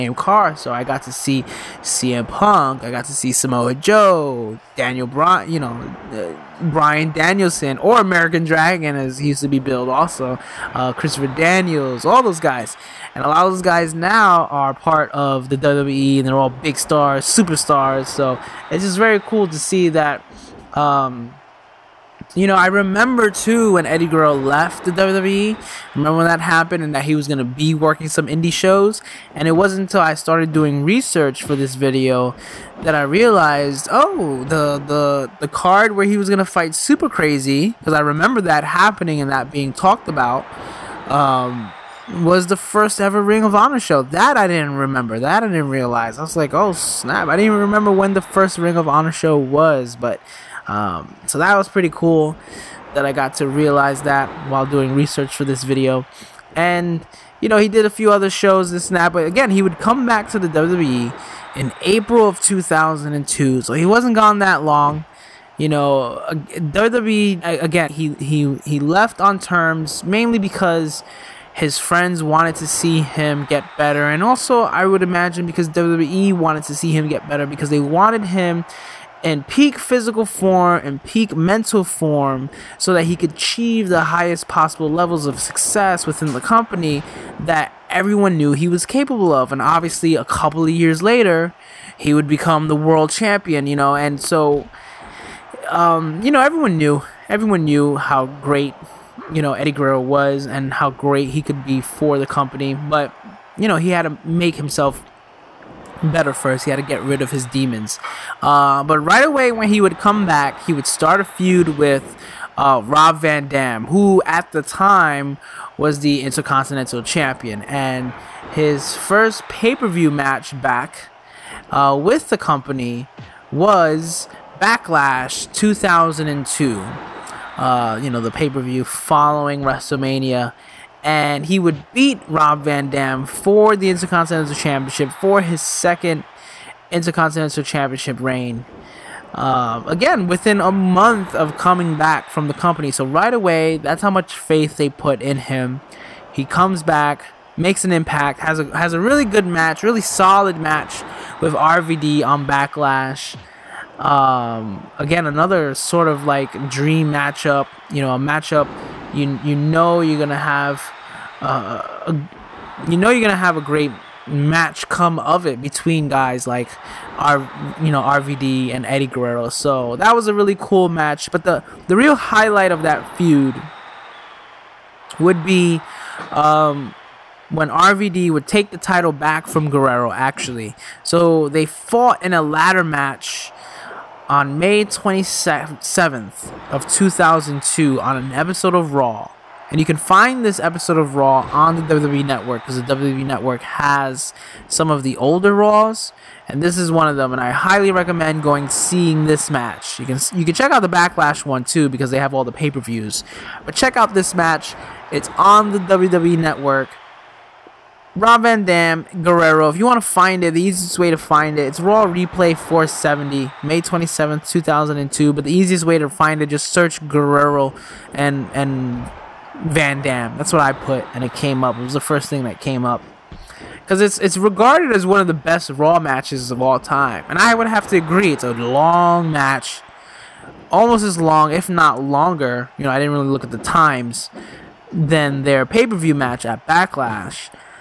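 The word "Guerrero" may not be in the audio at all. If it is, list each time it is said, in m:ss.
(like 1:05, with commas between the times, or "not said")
0:24, 1:39, 2:49, 2:59, 3:29, 3:37.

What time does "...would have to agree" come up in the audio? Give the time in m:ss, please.
3:47.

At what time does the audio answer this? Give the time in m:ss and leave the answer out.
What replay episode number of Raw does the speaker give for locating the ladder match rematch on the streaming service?
3:32.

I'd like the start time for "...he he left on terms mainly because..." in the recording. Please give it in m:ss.
1:08.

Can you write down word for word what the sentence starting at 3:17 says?
And I highly recommend going seeing this match.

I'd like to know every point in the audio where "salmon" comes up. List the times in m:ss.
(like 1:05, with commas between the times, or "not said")
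not said.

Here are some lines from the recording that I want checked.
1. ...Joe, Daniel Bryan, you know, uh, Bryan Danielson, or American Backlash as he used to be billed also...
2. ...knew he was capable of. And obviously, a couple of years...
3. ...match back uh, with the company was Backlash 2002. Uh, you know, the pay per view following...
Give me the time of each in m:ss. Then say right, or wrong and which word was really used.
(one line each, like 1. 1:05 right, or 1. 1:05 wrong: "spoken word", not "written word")
1. 0:03 wrong: "Dragon", not "Backlash"
2. 1:28 right
3. 2:00 right.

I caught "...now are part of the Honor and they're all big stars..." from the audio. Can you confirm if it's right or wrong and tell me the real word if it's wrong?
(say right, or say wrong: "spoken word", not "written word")
wrong: "WWE", not "Honor".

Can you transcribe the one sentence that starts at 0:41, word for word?
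Um, was the first ever Ring of Honor show.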